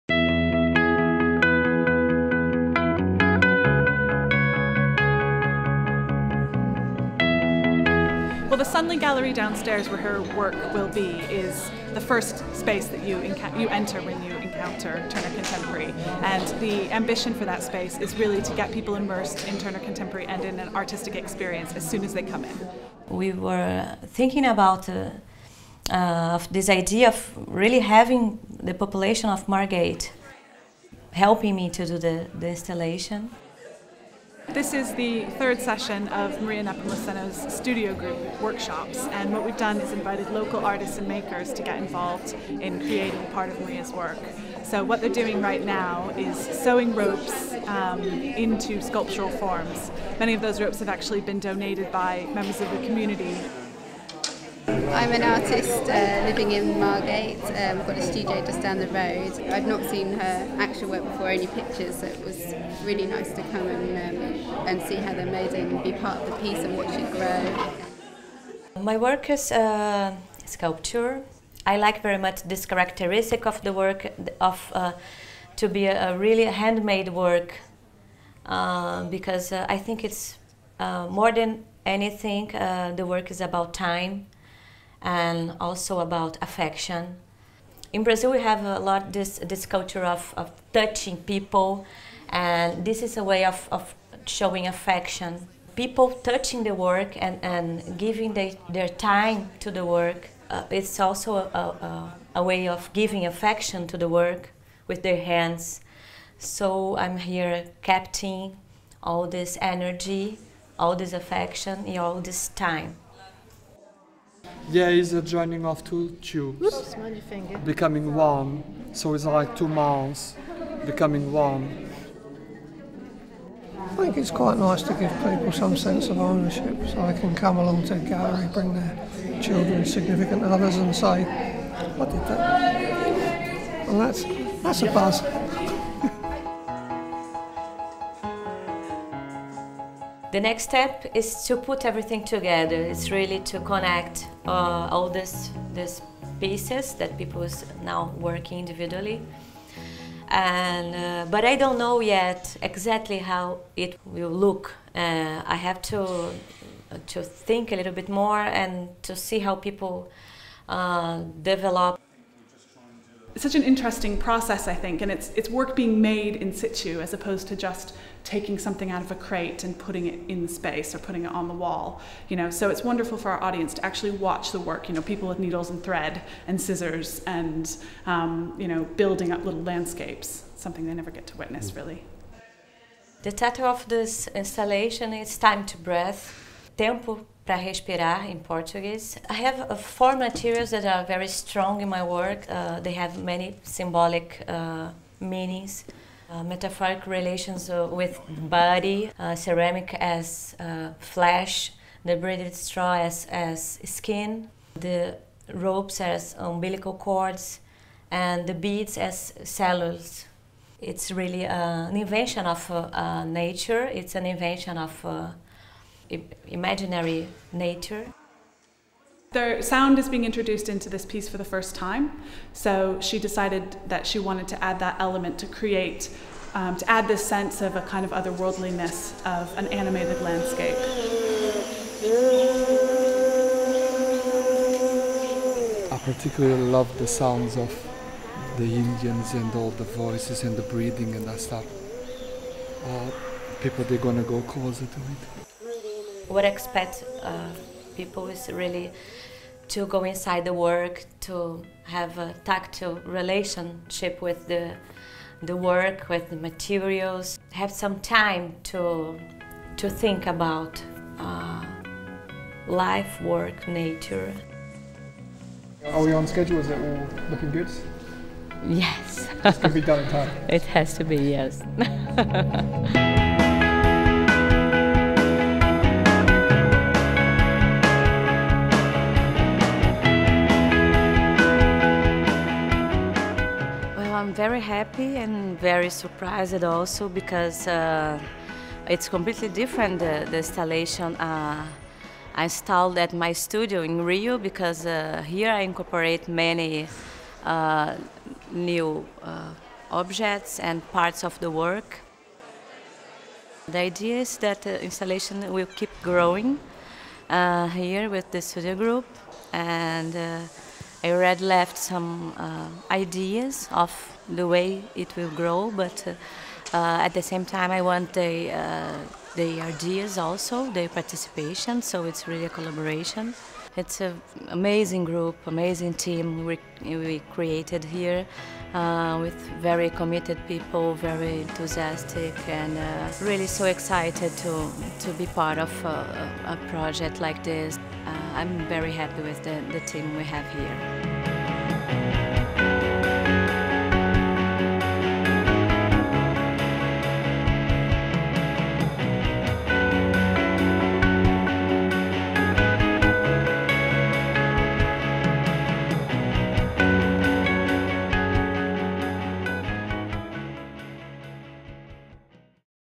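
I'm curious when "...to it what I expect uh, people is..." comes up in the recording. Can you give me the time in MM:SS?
04:04.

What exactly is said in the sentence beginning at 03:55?
I particularly love the sounds of the Indians and all the voices and the breathing, and that stuff.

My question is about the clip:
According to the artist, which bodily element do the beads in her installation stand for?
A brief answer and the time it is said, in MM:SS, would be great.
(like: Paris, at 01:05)
Cells, at 03:29.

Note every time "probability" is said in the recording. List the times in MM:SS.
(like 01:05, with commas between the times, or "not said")
not said.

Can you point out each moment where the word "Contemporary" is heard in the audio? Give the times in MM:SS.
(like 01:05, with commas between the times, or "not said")
00:15, 00:19.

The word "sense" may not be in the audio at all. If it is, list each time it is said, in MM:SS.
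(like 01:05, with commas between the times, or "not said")
02:05, 03:47.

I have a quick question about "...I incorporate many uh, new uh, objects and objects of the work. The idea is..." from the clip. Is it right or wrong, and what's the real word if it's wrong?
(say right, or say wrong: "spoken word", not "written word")
wrong: "parts", not "objects".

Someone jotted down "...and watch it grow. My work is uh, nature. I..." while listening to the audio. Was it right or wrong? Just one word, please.
wrong.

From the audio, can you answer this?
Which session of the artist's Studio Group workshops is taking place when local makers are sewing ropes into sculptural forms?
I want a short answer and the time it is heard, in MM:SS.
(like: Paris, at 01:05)
Third, at 00:35.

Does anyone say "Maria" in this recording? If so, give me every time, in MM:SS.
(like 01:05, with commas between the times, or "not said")
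00:36, 00:43.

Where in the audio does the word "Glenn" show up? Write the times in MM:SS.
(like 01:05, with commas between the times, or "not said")
not said.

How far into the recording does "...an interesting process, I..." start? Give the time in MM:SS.
02:43.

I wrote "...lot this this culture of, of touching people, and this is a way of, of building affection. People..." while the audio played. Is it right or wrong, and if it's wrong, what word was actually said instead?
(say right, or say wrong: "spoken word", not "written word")
wrong: "showing", not "building".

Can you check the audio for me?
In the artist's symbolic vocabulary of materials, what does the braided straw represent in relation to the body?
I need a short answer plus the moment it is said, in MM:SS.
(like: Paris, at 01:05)
Skin, at 03:23.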